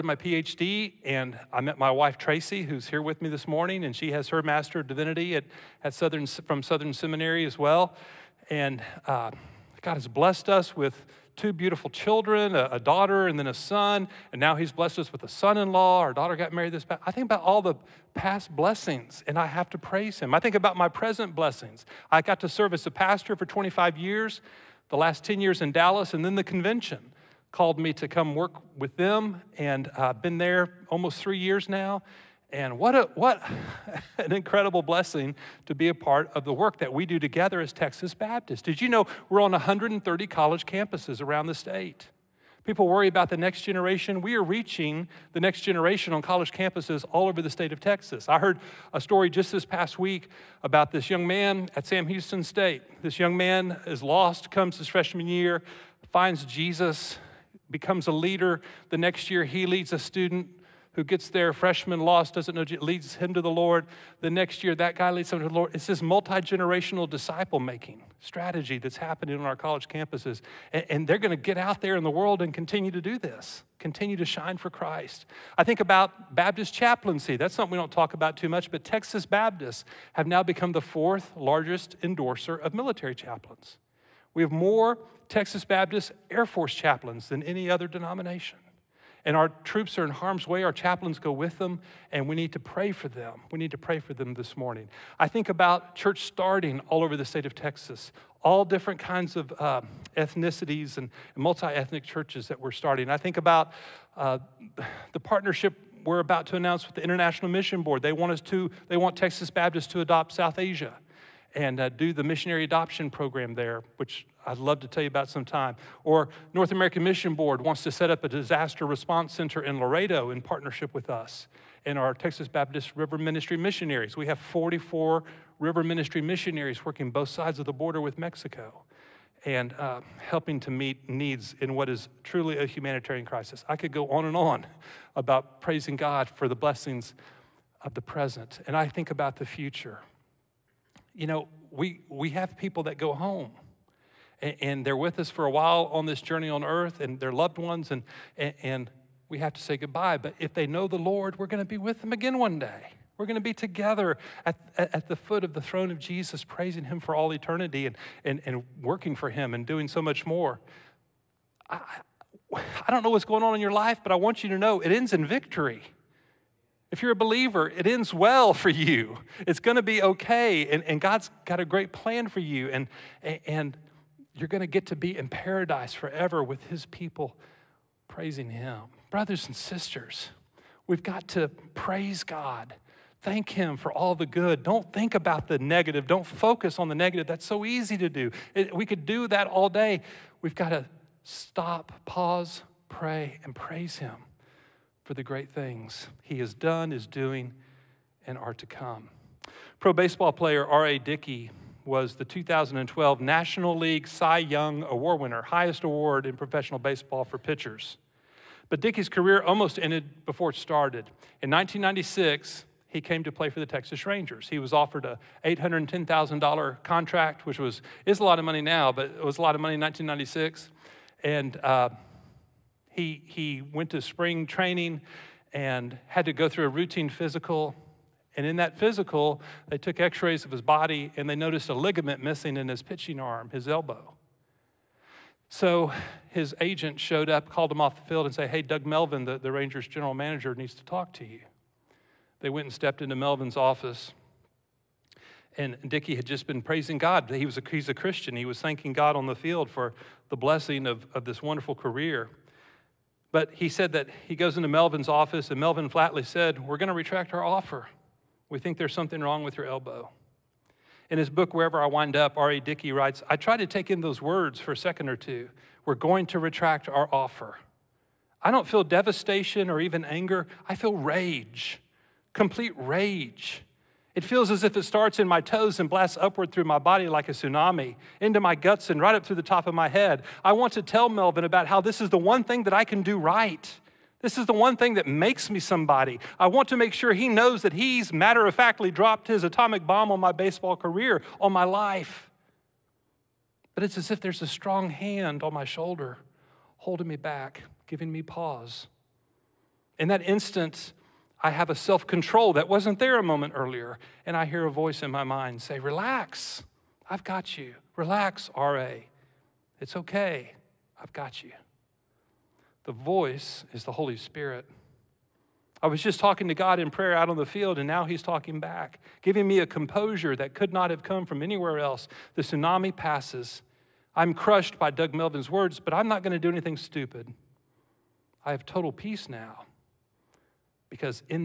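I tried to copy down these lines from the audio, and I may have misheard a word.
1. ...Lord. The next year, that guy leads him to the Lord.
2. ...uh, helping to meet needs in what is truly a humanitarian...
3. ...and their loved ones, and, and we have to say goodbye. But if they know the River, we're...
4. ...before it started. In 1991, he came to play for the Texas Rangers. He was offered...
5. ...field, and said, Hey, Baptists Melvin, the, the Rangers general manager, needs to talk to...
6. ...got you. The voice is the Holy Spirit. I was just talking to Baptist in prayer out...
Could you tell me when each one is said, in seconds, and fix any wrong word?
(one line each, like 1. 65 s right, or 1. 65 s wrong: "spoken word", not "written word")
1. 63 s right
2. 129 s right
3. 147 s wrong: "Lord", not "River"
4. 210 s wrong: "1996", not "1991"
5. 238 s wrong: "Doug", not "Baptists"
6. 311 s wrong: "God", not "Baptist".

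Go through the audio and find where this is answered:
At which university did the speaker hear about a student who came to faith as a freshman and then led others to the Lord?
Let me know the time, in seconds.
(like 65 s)
51 s.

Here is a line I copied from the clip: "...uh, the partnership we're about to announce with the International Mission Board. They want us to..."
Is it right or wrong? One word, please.
right.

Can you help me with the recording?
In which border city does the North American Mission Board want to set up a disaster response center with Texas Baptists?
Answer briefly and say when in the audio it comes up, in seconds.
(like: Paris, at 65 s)
Laredo, at 119 s.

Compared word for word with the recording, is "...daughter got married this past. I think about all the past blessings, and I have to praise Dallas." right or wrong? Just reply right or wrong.
wrong.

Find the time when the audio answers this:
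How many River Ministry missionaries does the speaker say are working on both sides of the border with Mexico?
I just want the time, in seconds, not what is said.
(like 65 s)
124 s.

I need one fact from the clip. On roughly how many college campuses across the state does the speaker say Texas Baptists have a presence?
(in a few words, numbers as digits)
130.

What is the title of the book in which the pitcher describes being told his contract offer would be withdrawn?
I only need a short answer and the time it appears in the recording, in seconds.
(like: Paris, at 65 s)
Wherever I Wind Up, at 261 s.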